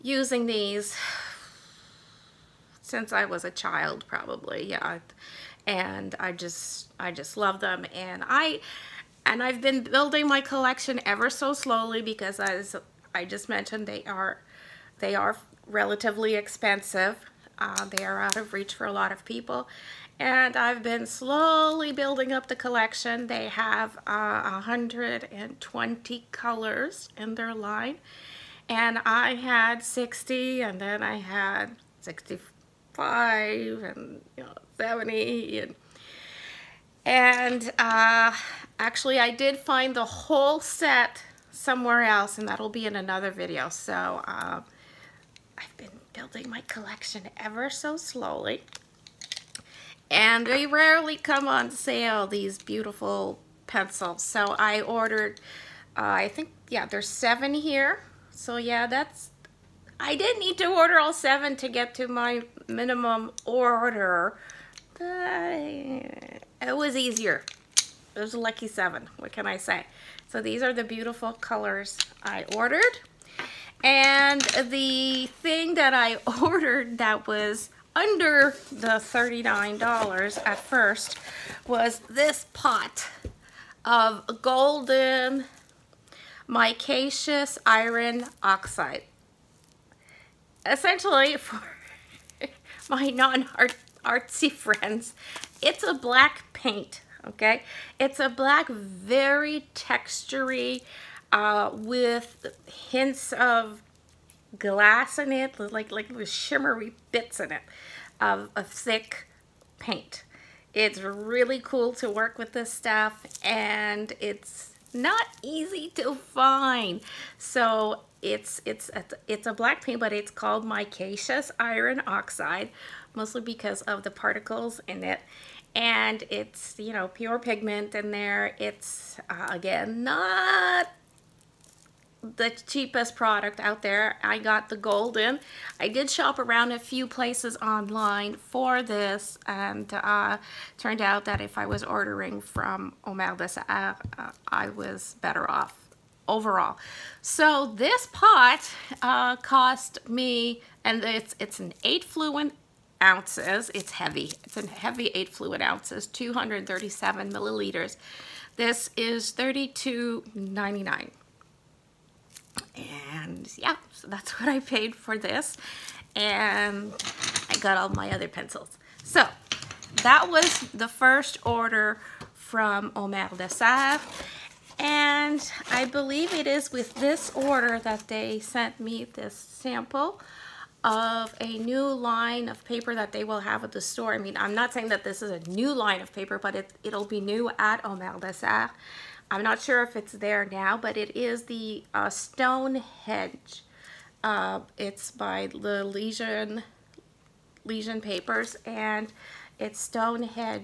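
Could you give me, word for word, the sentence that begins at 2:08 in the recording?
It's, uh, again, not the cheapest product out there.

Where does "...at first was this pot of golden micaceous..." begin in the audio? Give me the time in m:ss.
1:20.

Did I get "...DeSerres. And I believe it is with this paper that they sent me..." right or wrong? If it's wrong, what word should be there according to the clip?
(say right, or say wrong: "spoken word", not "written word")
wrong: "order", not "paper".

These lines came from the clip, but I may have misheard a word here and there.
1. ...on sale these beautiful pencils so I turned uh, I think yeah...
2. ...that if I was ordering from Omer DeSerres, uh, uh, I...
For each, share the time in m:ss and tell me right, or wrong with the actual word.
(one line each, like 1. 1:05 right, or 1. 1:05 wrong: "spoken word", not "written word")
1. 0:51 wrong: "ordered", not "turned"
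2. 2:21 right.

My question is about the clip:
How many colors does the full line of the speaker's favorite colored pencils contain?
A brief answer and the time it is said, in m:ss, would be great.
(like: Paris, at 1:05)
120, at 0:24.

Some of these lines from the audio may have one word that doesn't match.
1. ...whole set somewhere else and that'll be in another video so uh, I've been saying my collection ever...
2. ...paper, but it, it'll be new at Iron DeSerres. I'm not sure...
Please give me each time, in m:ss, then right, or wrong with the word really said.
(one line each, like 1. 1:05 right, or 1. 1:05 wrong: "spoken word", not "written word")
1. 0:40 wrong: "building", not "saying"
2. 3:06 wrong: "Omer", not "Iron".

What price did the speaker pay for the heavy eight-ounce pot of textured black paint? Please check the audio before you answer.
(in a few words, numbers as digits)
$32.99.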